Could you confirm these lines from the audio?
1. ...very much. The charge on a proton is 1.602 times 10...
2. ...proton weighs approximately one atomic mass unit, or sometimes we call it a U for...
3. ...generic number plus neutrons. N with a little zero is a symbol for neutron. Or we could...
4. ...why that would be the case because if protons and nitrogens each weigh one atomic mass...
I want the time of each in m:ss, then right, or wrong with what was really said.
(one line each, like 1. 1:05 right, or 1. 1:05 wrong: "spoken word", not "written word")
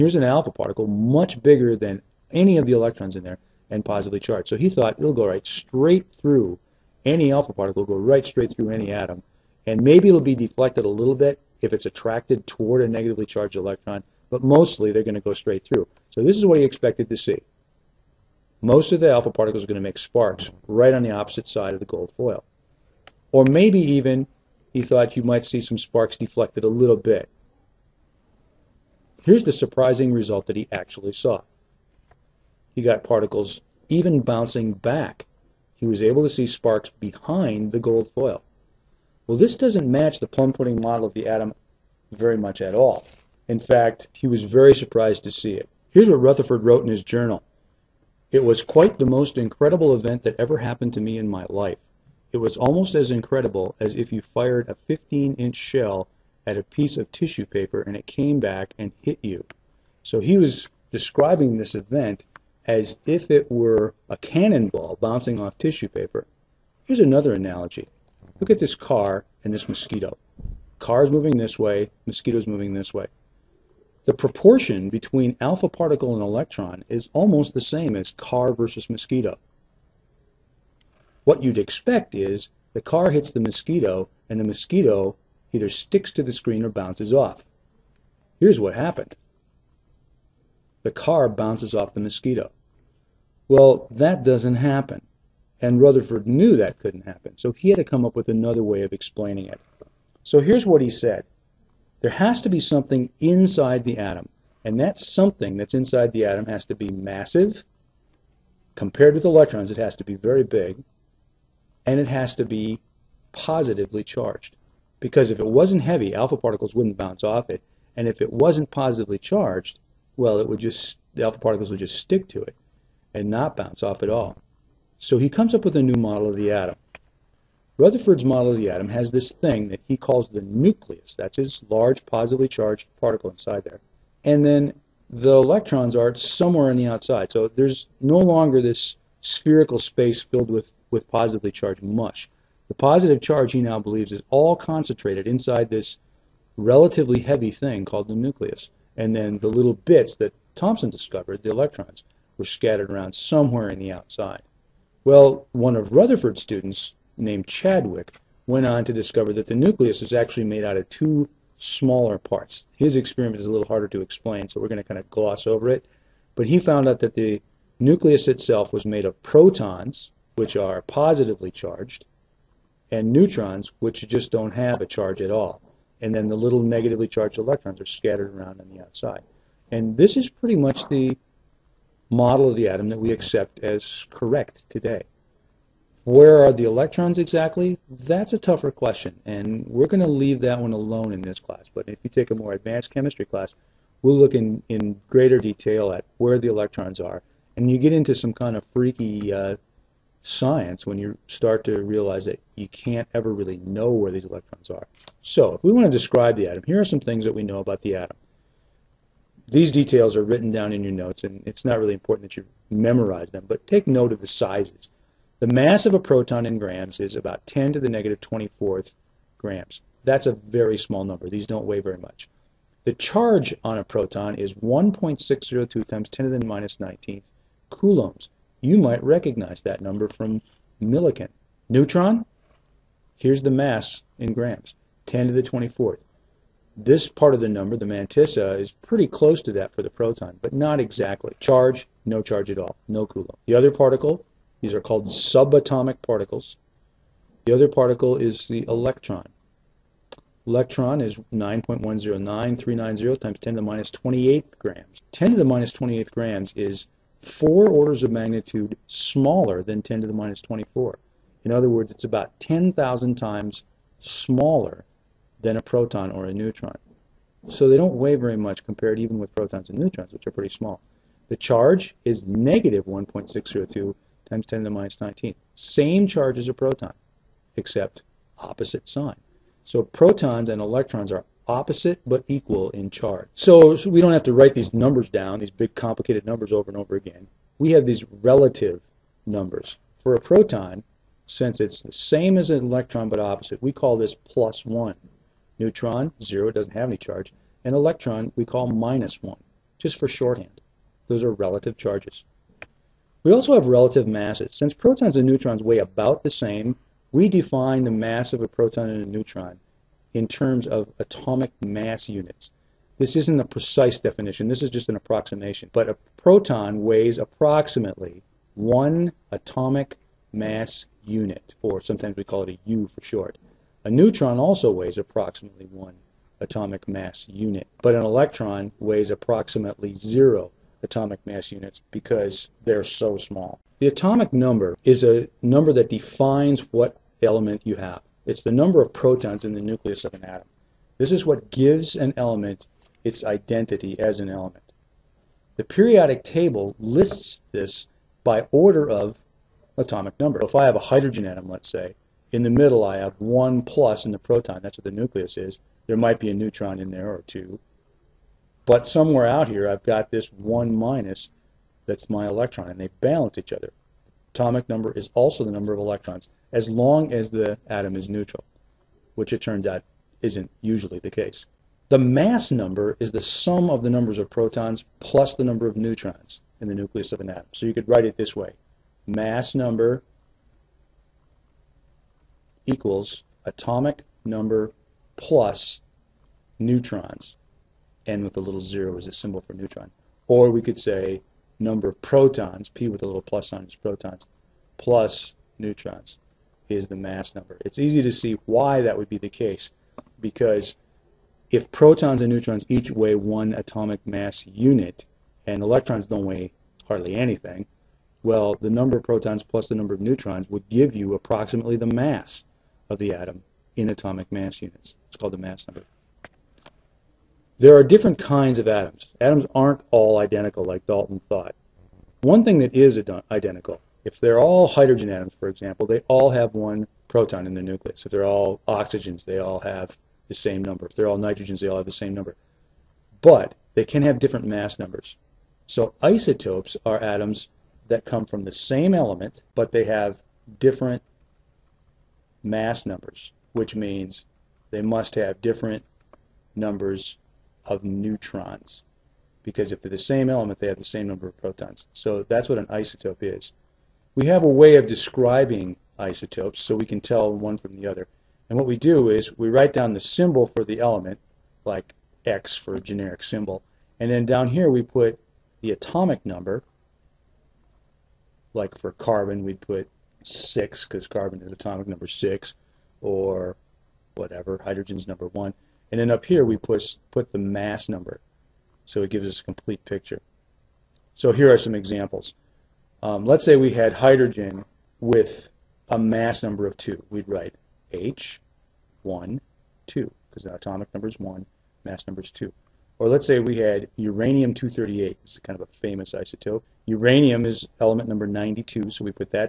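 1. 3:41 right
2. 5:16 right
3. 6:23 wrong: "atomic", not "generic"
4. 6:38 wrong: "neutrons", not "nitrogens".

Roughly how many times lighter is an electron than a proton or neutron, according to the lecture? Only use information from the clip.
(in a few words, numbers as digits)
10,000.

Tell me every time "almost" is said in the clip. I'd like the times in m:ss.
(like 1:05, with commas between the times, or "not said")
0:52, 1:17.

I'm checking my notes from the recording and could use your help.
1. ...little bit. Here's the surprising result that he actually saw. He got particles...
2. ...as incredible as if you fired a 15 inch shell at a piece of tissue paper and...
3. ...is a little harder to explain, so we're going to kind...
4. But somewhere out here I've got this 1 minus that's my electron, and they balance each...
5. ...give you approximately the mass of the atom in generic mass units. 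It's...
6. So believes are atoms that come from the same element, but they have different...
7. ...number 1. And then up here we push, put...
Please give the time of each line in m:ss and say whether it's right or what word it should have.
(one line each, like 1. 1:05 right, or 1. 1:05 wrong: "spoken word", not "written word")
1. 0:26 right
2. 0:52 right
3. 2:43 right
4. 5:58 right
5. 6:50 wrong: "atomic", not "generic"
6. 7:15 wrong: "isotopes", not "believes"
7. 7:55 right.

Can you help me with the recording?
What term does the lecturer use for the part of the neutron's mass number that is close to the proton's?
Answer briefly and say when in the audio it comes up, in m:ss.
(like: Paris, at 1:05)
mantissa, at 3:57.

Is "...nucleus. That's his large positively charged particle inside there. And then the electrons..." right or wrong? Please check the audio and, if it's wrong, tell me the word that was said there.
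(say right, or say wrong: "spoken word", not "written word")
right.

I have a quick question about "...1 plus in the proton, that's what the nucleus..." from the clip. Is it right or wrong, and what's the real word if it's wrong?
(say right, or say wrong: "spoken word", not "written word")
right.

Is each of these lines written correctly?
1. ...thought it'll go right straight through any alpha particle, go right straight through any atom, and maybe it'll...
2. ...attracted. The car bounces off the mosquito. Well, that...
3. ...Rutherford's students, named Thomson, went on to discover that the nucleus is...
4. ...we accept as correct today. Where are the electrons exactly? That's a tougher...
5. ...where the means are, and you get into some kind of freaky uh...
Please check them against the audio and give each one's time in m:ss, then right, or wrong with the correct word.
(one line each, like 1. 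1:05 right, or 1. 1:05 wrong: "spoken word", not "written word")
1. 0:04 right
2. 1:28 wrong: "happened", not "attracted"
3. 2:35 wrong: "Chadwick", not "Thomson"
4. 3:02 right
5. 3:16 wrong: "electrons", not "means".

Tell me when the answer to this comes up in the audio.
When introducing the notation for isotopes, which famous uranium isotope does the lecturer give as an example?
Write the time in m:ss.
8:13.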